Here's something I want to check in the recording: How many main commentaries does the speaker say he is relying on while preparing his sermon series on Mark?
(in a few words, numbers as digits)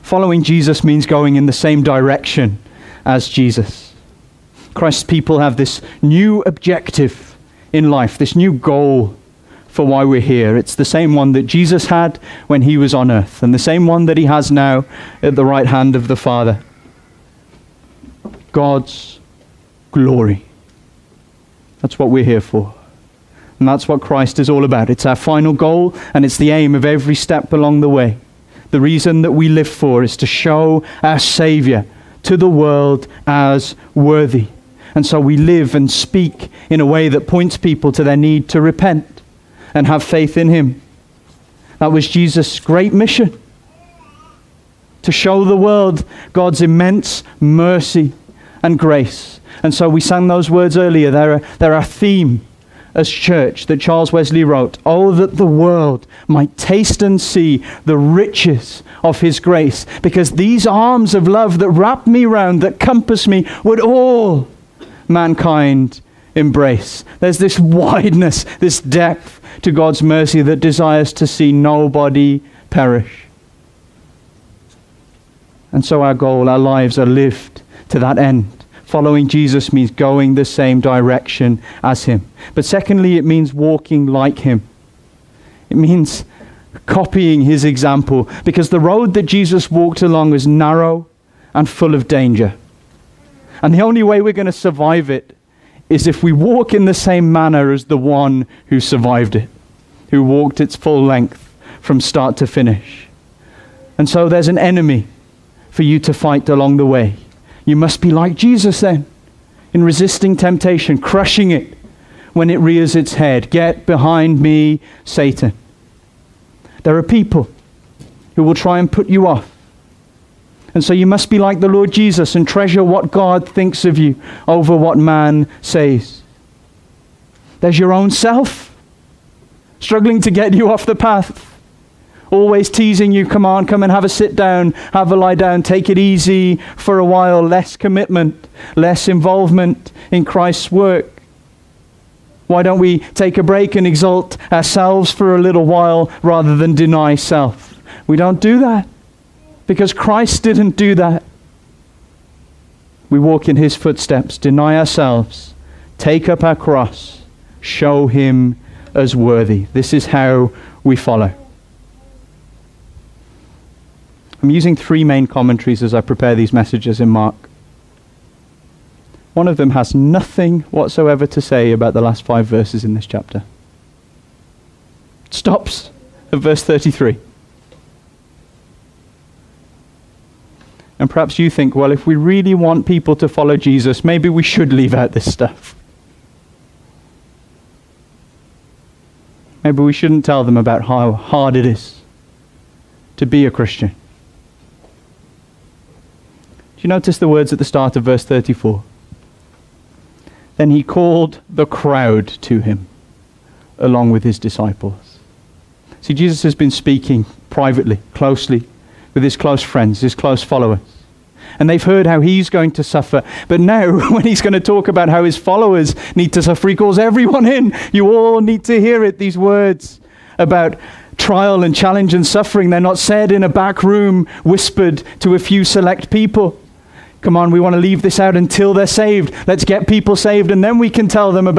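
3.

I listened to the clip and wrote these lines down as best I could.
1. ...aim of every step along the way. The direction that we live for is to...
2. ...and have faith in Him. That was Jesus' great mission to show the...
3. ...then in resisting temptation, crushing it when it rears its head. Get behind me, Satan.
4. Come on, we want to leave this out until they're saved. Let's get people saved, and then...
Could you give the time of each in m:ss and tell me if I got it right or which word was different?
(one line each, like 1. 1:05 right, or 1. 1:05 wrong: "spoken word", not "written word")
1. 0:26 wrong: "reason", not "direction"
2. 0:39 right
3. 1:48 right
4. 3:47 right.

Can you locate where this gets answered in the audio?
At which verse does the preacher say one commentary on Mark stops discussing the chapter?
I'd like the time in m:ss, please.
2:56.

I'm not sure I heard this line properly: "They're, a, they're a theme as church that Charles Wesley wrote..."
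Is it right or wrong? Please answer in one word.
right.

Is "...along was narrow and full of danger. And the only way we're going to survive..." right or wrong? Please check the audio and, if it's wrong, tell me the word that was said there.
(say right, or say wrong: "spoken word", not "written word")
right.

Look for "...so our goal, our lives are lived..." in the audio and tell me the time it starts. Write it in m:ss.
1:15.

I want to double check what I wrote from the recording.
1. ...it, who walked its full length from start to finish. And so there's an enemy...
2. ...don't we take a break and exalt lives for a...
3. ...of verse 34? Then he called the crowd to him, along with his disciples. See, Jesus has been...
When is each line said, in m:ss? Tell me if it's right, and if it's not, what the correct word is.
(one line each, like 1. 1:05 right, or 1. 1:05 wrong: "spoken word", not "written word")
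1. 1:39 right
2. 2:22 wrong: "ourselves", not "lives"
3. 3:17 right.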